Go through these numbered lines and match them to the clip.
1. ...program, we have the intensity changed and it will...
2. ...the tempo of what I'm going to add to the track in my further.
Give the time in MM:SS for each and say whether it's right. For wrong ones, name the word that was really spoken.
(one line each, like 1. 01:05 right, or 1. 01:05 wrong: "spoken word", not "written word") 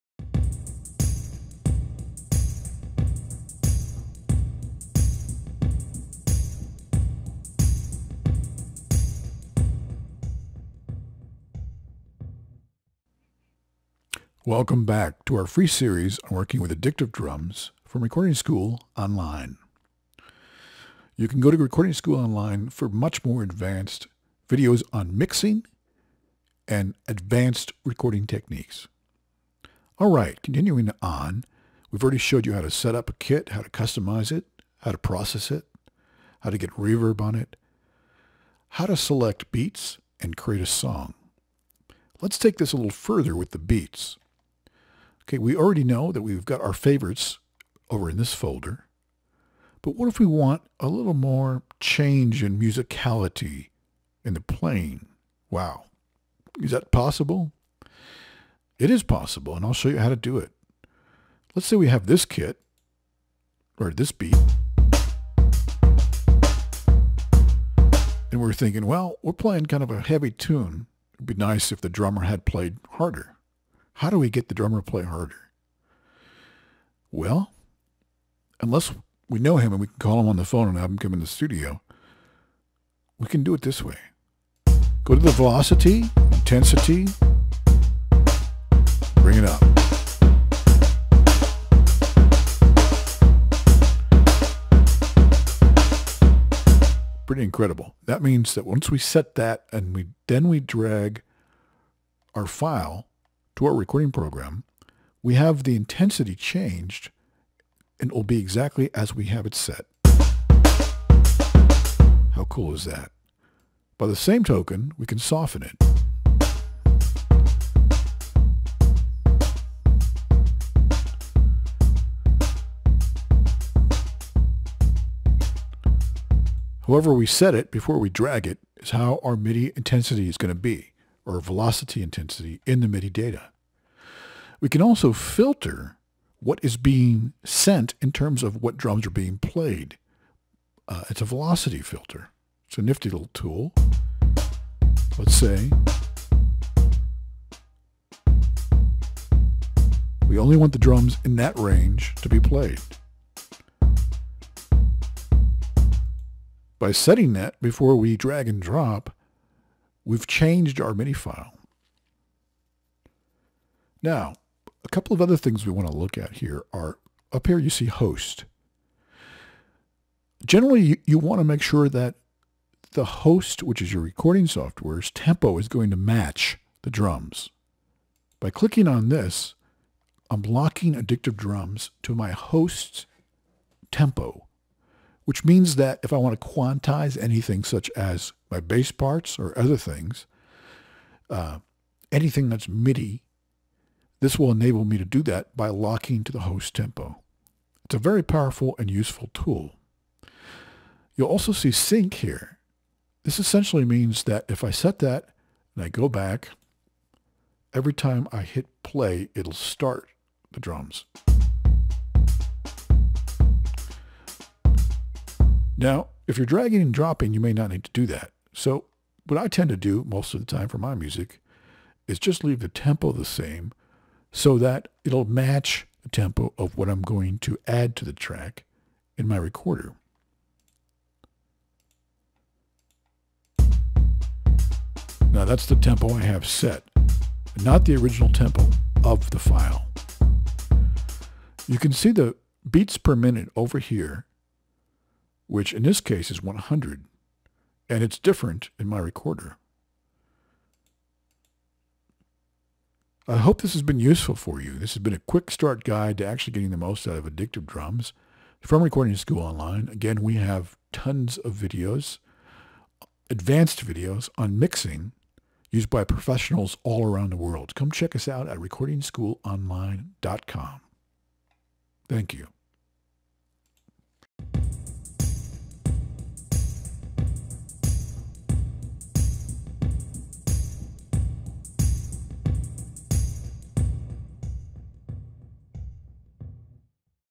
1. 01:44 right
2. 03:46 wrong: "recorder", not "further".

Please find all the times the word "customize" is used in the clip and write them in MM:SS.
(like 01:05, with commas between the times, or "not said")
00:33.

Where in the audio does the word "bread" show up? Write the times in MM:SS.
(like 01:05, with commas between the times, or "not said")
not said.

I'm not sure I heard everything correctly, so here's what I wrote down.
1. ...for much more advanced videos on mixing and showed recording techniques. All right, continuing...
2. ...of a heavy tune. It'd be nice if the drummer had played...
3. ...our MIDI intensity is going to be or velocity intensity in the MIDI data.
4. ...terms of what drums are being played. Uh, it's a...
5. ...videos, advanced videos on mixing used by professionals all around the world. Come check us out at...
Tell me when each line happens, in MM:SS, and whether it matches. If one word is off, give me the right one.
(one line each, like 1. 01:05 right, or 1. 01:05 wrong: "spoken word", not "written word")
1. 00:22 wrong: "advanced", not "showed"
2. 01:09 right
3. 02:09 right
4. 02:18 right
5. 04:21 right.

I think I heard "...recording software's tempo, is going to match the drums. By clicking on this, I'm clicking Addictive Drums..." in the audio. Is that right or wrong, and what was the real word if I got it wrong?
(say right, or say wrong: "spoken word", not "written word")
wrong: "locking", not "clicking".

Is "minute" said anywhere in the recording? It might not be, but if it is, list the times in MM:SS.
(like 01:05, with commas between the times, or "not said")
04:03.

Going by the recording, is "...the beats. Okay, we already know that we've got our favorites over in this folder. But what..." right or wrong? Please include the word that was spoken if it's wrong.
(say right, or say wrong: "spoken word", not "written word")
right.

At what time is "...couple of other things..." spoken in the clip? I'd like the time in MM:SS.
02:44.